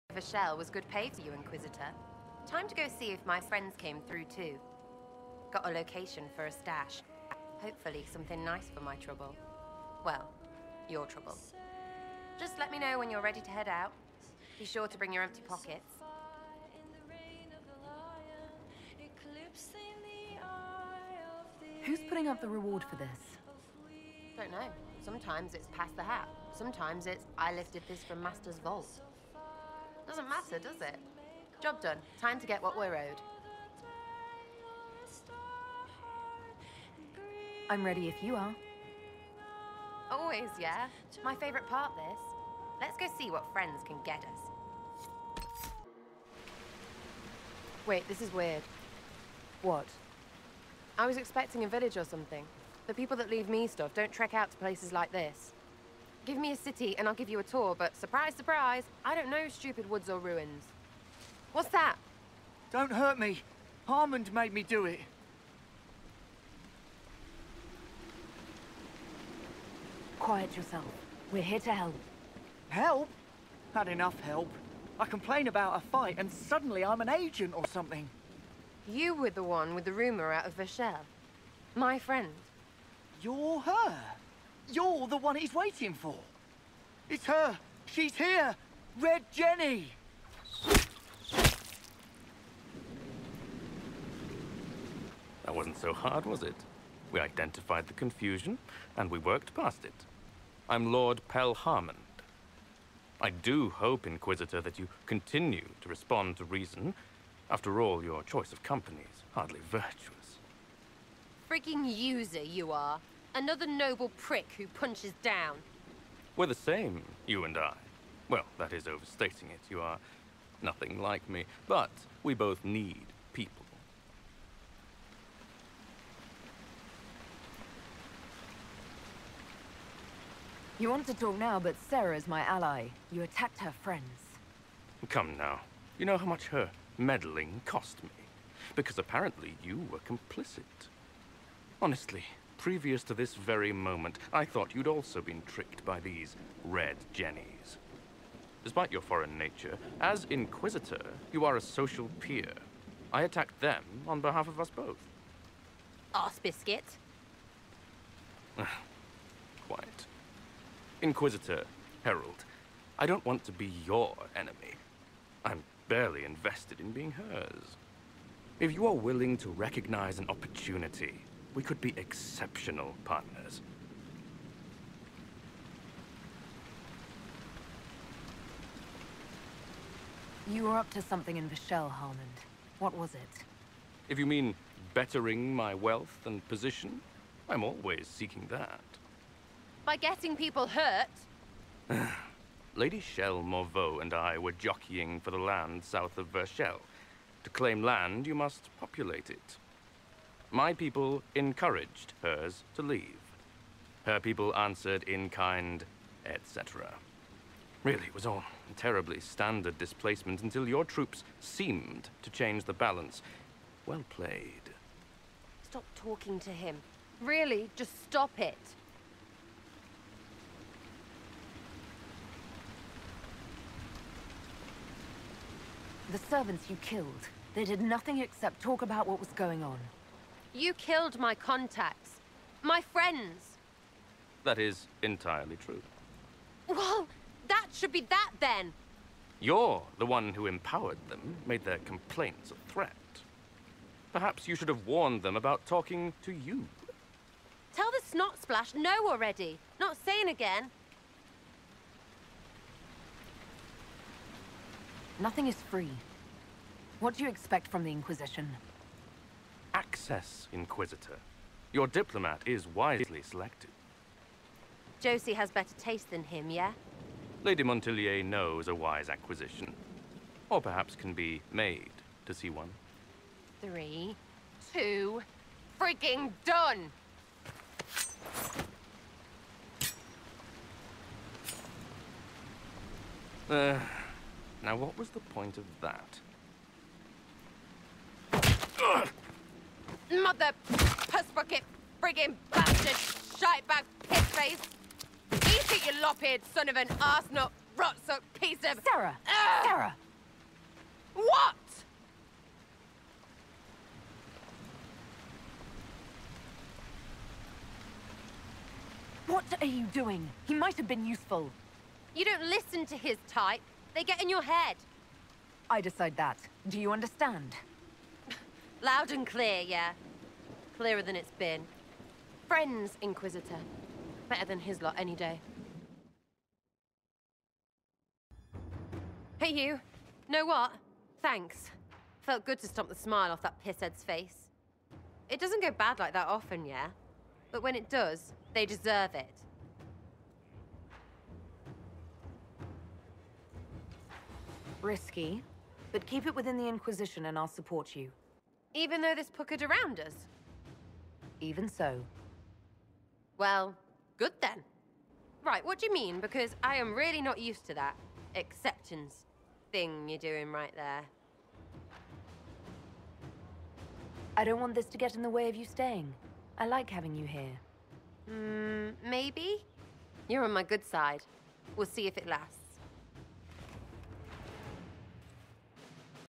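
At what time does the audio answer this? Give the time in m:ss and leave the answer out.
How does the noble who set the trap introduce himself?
1:40.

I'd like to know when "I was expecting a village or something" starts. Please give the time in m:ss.
0:50.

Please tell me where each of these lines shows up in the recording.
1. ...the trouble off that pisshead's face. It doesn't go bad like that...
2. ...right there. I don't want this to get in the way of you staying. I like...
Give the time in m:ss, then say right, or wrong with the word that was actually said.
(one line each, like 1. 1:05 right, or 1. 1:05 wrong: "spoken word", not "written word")
1. 5:32 wrong: "smile", not "trouble"
2. 6:00 right.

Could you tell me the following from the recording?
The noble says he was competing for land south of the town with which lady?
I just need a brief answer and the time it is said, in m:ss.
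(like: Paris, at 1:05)
Lady Shell Morveau, at 3:12.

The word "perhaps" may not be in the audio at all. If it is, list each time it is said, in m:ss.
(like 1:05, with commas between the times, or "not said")
4:04, 4:30.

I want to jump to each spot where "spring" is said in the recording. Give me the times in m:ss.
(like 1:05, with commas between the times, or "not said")
not said.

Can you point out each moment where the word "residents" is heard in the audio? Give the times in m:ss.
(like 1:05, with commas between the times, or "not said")
not said.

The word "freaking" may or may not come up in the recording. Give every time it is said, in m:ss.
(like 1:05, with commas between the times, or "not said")
1:51, 4:35.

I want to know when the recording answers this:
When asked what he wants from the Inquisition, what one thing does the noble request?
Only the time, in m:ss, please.
4:19.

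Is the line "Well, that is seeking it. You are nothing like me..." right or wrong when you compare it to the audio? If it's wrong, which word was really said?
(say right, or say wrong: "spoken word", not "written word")
wrong: "overstating", not "seeking".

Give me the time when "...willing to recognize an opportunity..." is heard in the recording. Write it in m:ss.
2:48.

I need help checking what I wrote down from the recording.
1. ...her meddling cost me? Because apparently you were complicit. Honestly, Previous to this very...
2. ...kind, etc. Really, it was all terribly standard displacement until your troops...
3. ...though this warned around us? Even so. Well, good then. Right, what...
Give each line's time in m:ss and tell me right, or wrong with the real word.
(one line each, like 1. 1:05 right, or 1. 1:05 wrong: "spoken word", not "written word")
1. 2:16 right
2. 3:25 right
3. 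5:49 wrong: "puckered", not "warned".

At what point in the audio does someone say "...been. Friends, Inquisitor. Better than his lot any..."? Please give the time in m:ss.
5:21.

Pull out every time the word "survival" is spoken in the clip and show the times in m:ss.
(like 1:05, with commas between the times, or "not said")
not said.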